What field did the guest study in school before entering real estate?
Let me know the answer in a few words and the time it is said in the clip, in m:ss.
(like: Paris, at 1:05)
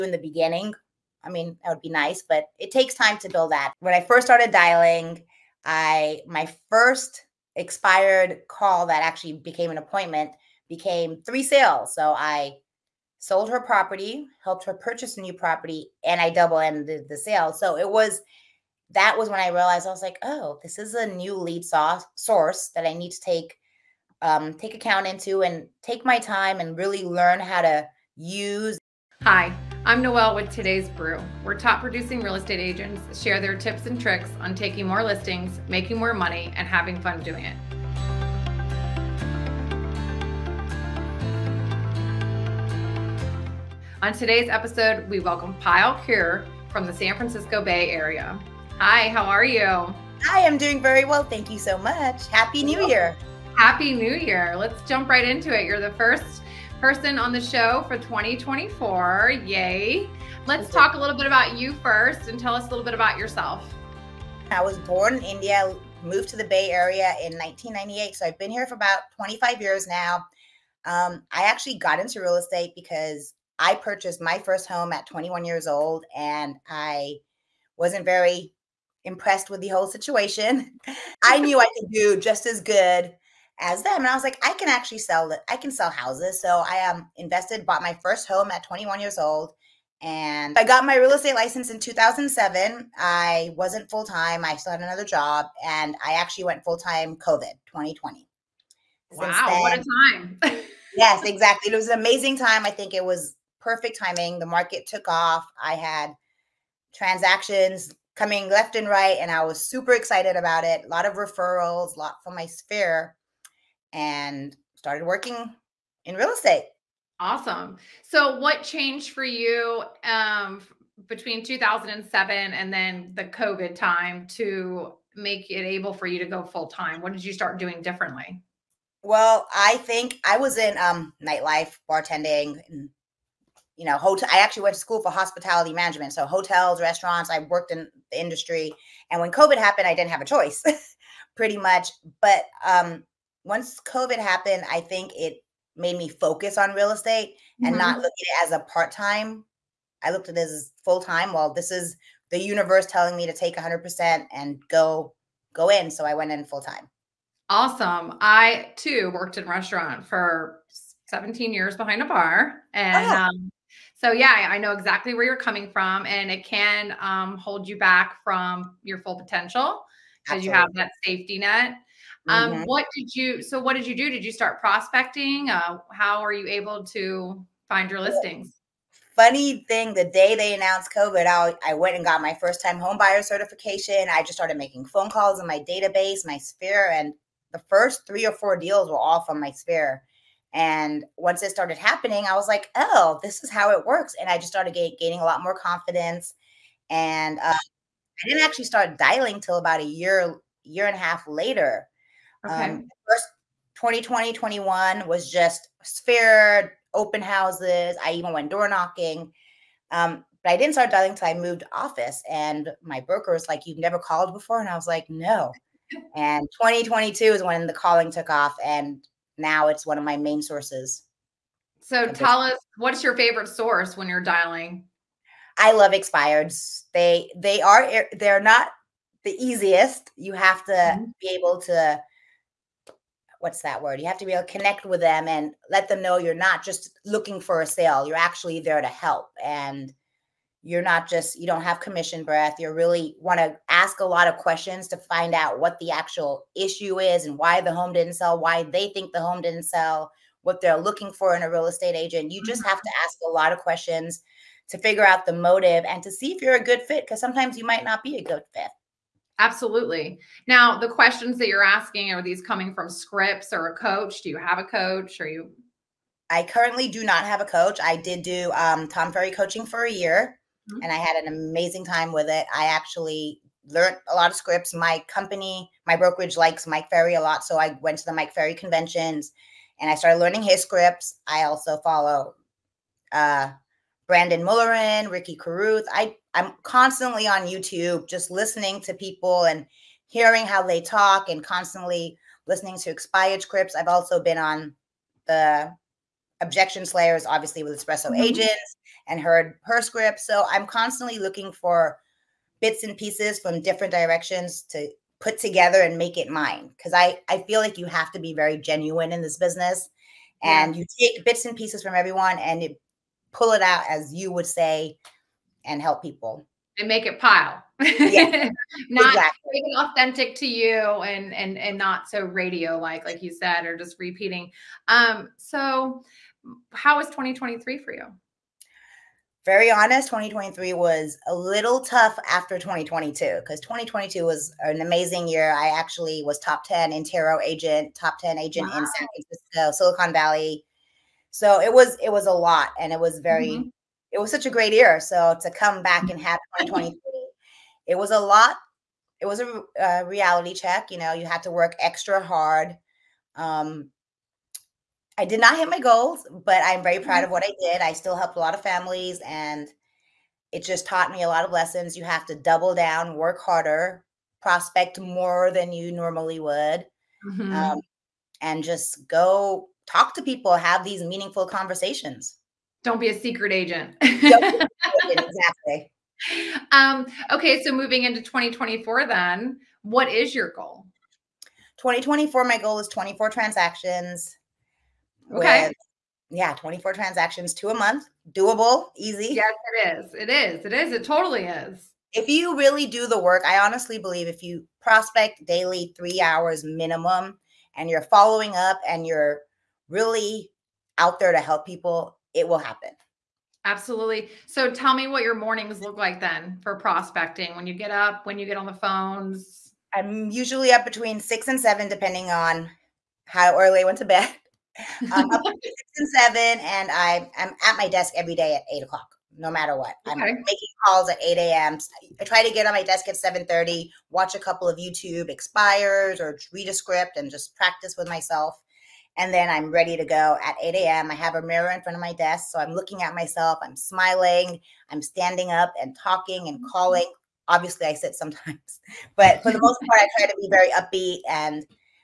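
Hospitality management, at 2:15.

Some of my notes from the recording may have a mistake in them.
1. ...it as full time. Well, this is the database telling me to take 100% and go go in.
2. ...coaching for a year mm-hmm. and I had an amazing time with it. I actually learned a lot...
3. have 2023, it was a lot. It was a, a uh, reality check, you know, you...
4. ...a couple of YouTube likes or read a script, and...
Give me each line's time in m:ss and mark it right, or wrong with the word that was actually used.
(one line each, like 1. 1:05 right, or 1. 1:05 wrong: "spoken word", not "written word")
1. 2:30 wrong: "universe", not "database"
2. 4:29 right
3. 5:46 right
4. 7:04 wrong: "expires", not "likes".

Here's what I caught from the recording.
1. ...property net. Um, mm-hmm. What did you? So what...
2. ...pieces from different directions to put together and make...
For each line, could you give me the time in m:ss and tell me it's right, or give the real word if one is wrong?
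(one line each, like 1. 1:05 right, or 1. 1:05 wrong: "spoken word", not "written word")
1. 2:51 wrong: "safety", not "property"
2. 5:02 right.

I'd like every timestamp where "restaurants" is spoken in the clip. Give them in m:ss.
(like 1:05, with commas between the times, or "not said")
2:16, 2:39.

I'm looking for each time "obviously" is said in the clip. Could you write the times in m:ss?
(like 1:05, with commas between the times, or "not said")
4:57, 7:17.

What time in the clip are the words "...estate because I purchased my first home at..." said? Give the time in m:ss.
1:12.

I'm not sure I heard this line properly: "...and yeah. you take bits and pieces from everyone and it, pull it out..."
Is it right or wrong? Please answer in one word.
right.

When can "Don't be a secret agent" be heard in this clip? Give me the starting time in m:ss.
6:12.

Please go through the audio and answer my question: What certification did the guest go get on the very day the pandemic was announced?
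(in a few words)
First time homebuyer certification.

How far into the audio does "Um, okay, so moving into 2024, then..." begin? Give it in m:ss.
6:16.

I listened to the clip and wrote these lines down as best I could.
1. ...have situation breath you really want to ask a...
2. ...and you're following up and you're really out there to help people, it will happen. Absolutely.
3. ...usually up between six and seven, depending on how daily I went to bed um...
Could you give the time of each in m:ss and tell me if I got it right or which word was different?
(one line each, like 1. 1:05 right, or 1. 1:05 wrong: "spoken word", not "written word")
1. 4:01 wrong: "commission", not "situation"
2. 6:37 right
3. 6:50 wrong: "early", not "daily".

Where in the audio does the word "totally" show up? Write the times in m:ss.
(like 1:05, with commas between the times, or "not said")
6:31.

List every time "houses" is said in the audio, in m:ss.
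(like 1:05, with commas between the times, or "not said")
1:25, 3:27.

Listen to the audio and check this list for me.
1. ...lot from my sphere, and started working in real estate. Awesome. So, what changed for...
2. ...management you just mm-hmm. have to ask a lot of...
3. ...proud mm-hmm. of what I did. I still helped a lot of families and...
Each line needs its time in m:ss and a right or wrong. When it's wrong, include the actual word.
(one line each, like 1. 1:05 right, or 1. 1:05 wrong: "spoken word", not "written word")
1. 1:51 right
2. 4:11 wrong: "agent", not "management"
3. 5:56 right.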